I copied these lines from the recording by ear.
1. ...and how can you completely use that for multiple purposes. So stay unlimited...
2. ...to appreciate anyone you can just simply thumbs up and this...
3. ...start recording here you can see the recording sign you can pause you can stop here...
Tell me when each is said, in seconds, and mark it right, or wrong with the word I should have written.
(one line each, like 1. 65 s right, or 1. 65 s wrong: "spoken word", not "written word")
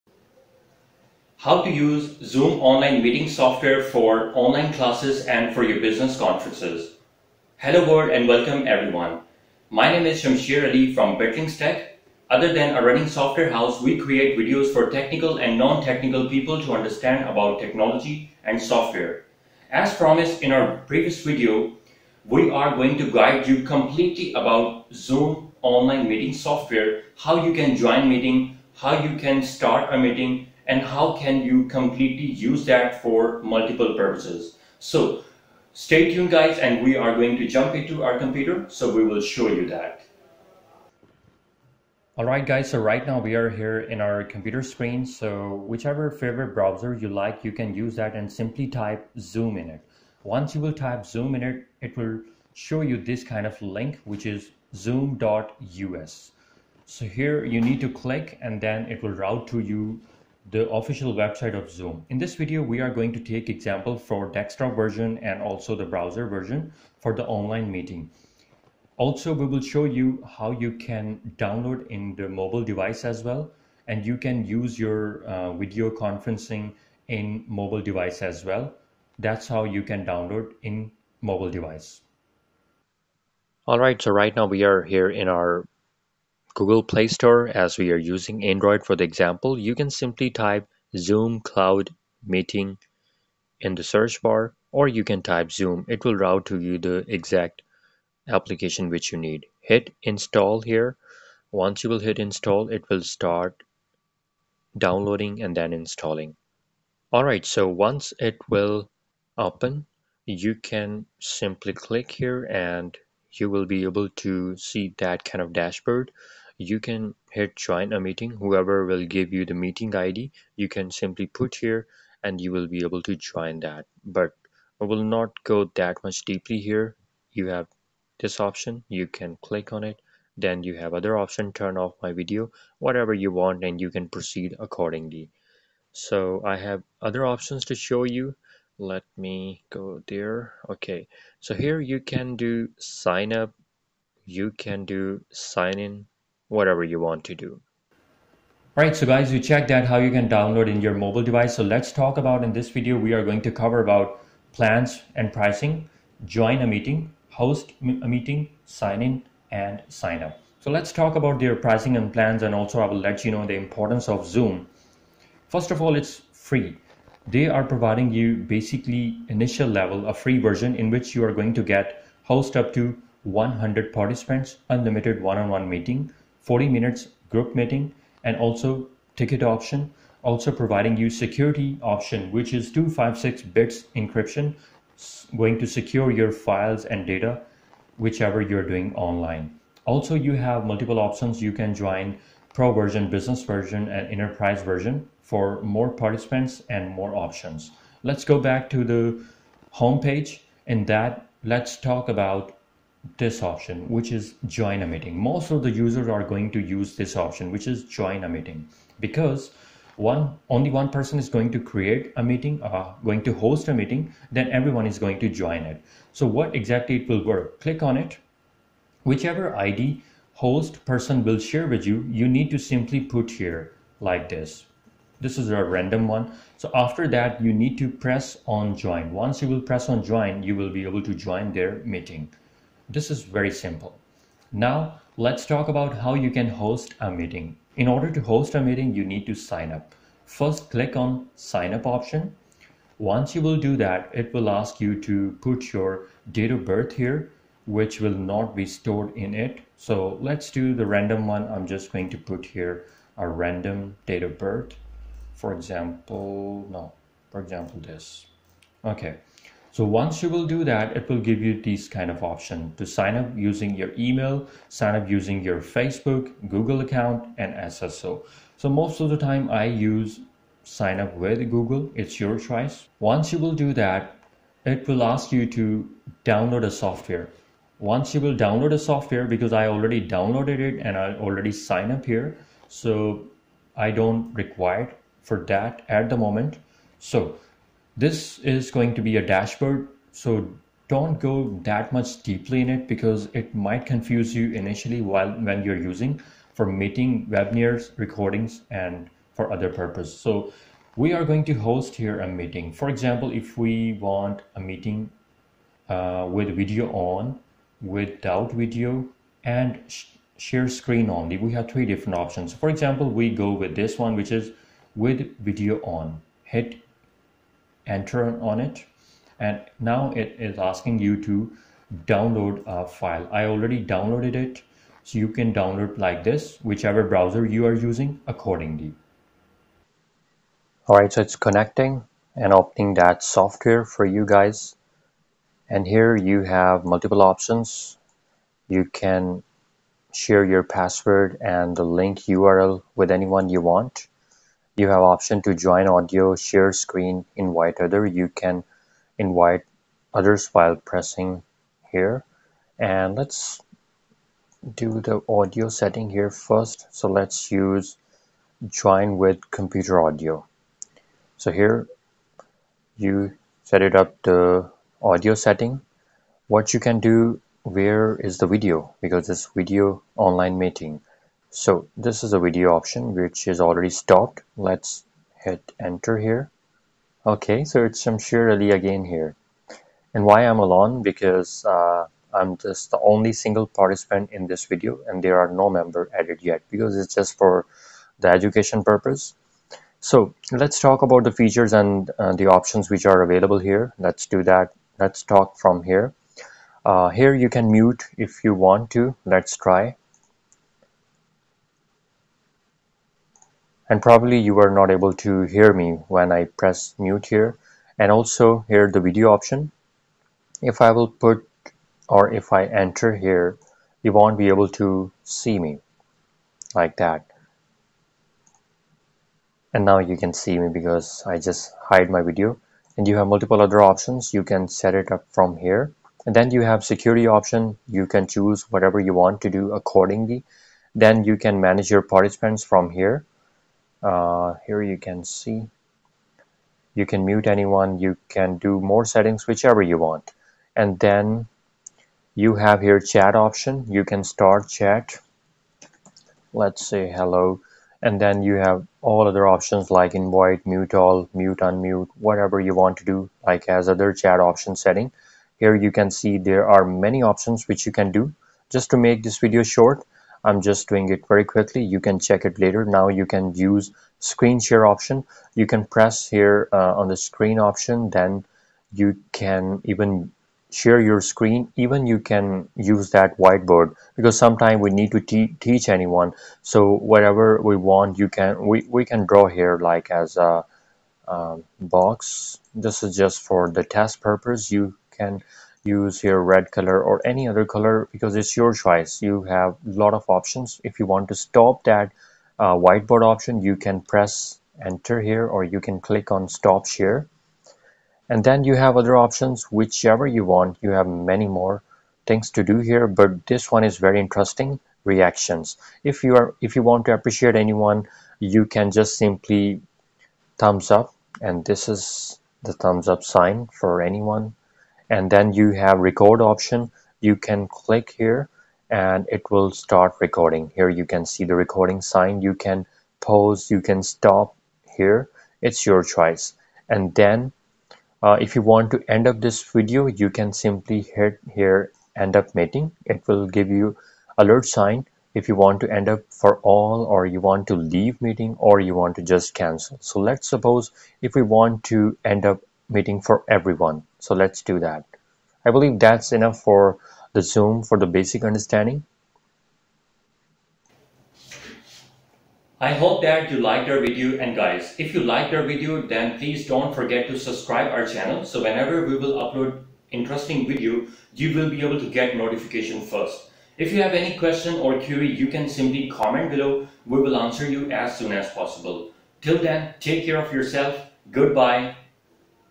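1. 30 s wrong: "tuned", not "unlimited"
2. 507 s right
3. 519 s right.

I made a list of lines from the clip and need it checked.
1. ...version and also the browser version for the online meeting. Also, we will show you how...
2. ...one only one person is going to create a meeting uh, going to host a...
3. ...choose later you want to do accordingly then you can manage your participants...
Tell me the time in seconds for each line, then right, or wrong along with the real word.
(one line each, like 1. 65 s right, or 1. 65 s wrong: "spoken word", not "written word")
1. 64 s right
2. 209 s right
3. 428 s wrong: "whatever", not "later".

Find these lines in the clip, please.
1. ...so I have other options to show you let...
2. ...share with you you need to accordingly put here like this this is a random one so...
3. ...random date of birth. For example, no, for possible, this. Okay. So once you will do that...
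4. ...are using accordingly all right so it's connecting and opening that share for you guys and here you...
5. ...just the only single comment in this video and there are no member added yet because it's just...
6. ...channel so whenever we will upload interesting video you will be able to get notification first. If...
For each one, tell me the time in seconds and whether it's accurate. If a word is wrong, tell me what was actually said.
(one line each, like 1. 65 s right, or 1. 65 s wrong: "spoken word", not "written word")
1. 135 s right
2. 221 s wrong: "simply", not "accordingly"
3. 253 s wrong: "example", not "possible"
4. 327 s wrong: "software", not "share"
5. 382 s wrong: "participant", not "comment"
6. 558 s right.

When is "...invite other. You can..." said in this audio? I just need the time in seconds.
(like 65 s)
347 s.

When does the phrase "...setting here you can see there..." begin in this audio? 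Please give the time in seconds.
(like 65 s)
454 s.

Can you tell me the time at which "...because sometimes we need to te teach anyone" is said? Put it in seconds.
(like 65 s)
474 s.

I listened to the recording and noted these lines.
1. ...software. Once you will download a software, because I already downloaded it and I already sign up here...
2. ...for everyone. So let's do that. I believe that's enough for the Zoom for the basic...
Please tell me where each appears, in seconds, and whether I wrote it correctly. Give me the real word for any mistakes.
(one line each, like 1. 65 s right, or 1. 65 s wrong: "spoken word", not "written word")
1. 276 s right
2. 543 s right.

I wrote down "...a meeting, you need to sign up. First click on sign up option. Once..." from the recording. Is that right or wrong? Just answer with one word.
right.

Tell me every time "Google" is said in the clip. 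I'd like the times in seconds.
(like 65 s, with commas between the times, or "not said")
86 s, 266 s, 271 s.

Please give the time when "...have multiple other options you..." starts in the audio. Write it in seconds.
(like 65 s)
423 s.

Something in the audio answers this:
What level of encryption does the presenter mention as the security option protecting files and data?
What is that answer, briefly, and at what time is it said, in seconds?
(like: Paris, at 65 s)
256 bits, at 182 s.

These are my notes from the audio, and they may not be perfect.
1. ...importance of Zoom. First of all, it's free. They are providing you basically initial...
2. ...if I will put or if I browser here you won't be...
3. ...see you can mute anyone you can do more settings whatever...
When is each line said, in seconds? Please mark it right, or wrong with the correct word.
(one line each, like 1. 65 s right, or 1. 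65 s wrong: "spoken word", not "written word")
1. 163 s right
2. 410 s wrong: "enter", not "browser"
3. 435 s wrong: "whichever", not "whatever".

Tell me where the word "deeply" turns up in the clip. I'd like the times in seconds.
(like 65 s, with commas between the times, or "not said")
126 s, 292 s.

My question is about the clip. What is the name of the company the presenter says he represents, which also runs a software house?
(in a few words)
Bitlinks Tech.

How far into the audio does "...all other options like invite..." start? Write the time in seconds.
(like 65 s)
449 s.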